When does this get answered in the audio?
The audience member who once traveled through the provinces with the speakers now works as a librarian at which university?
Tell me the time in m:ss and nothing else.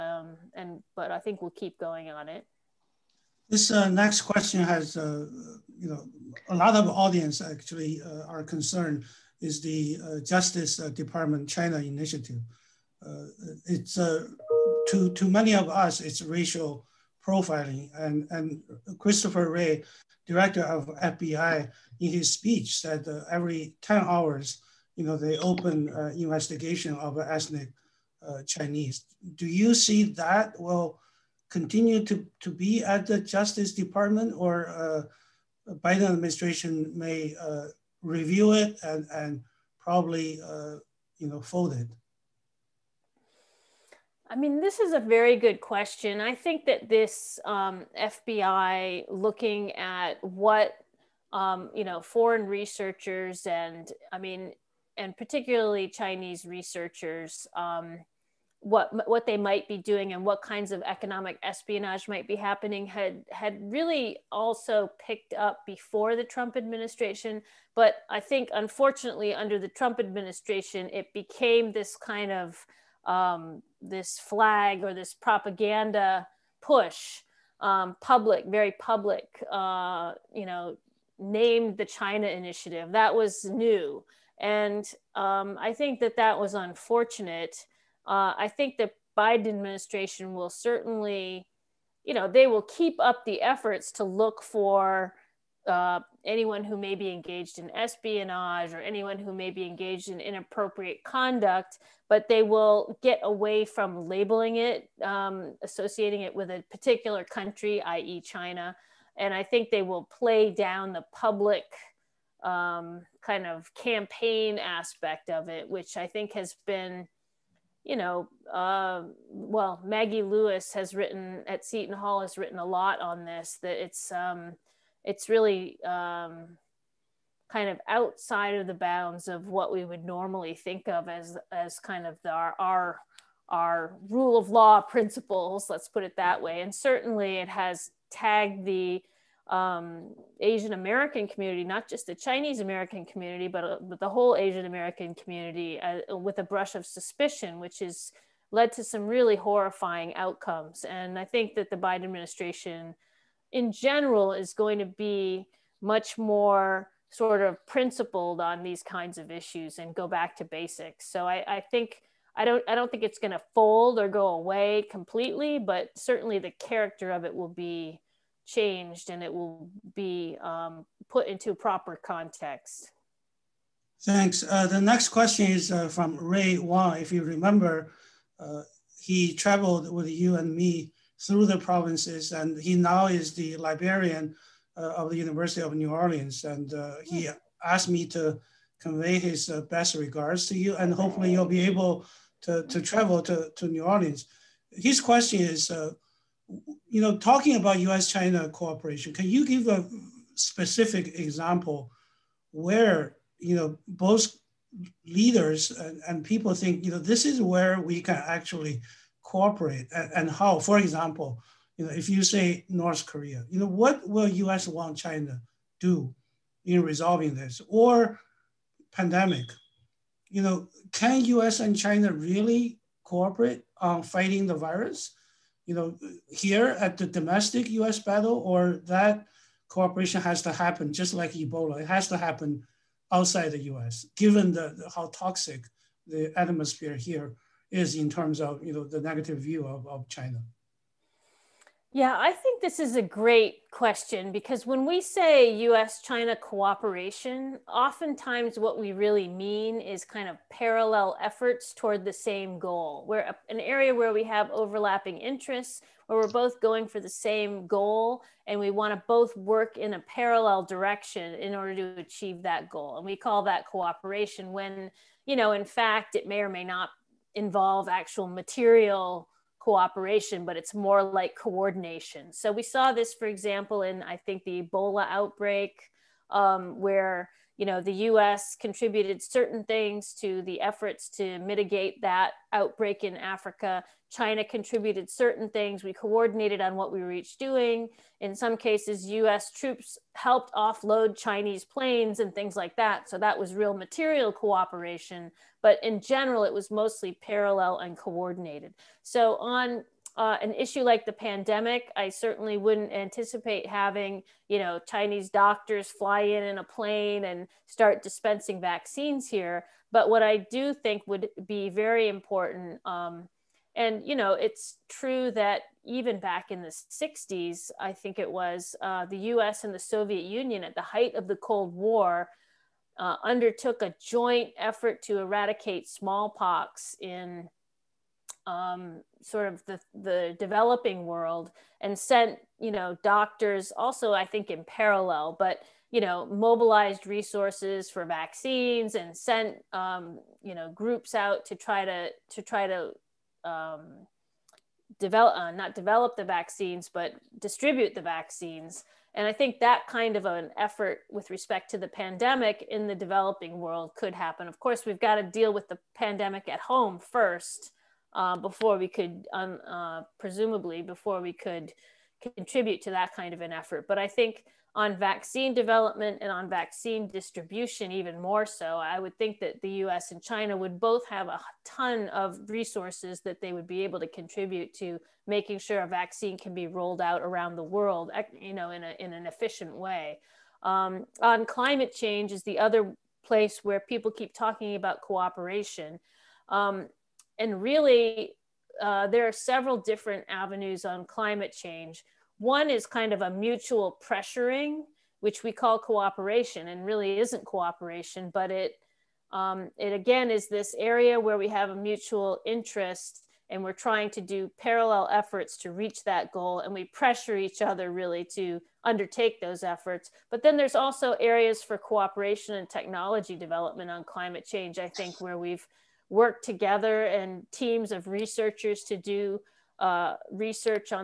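3:05.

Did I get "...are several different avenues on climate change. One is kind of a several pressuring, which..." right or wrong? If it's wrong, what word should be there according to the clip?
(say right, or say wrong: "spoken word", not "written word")
wrong: "mutual", not "several".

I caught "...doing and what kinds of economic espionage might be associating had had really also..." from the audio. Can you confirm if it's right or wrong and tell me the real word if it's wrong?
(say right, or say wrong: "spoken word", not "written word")
wrong: "happening", not "associating".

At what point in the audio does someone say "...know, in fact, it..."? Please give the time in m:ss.
4:25.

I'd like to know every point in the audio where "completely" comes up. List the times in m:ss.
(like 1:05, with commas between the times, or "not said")
2:44.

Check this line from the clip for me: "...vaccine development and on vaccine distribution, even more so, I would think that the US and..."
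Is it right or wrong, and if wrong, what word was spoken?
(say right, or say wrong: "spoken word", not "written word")
right.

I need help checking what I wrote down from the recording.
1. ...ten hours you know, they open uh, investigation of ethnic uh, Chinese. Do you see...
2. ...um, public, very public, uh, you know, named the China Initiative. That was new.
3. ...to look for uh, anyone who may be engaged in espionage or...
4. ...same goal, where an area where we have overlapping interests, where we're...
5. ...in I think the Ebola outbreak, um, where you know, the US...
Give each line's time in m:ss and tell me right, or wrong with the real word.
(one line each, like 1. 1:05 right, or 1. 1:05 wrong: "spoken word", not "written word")
1. 0:23 right
2. 1:17 right
3. 1:33 right
4. 4:12 right
5. 4:33 right.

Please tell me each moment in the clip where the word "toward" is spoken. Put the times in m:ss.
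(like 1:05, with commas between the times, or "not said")
4:11.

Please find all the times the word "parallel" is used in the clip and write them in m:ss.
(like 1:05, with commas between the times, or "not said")
4:10, 4:19, 4:57, 5:34, 6:44.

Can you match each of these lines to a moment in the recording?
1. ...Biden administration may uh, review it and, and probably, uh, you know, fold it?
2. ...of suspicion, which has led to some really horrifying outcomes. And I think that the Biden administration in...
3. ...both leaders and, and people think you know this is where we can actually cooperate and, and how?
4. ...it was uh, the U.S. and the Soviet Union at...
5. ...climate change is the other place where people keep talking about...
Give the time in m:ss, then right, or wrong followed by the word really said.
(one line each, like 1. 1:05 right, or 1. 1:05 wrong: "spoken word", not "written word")
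1. 0:35 right
2. 2:26 right
3. 3:23 right
4. 5:18 right
5. 6:21 right.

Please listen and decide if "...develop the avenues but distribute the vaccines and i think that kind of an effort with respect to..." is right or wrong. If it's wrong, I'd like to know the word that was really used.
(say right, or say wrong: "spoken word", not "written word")
wrong: "vaccines", not "avenues".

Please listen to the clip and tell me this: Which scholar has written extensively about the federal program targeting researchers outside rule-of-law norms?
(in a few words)
Maggie Lewis.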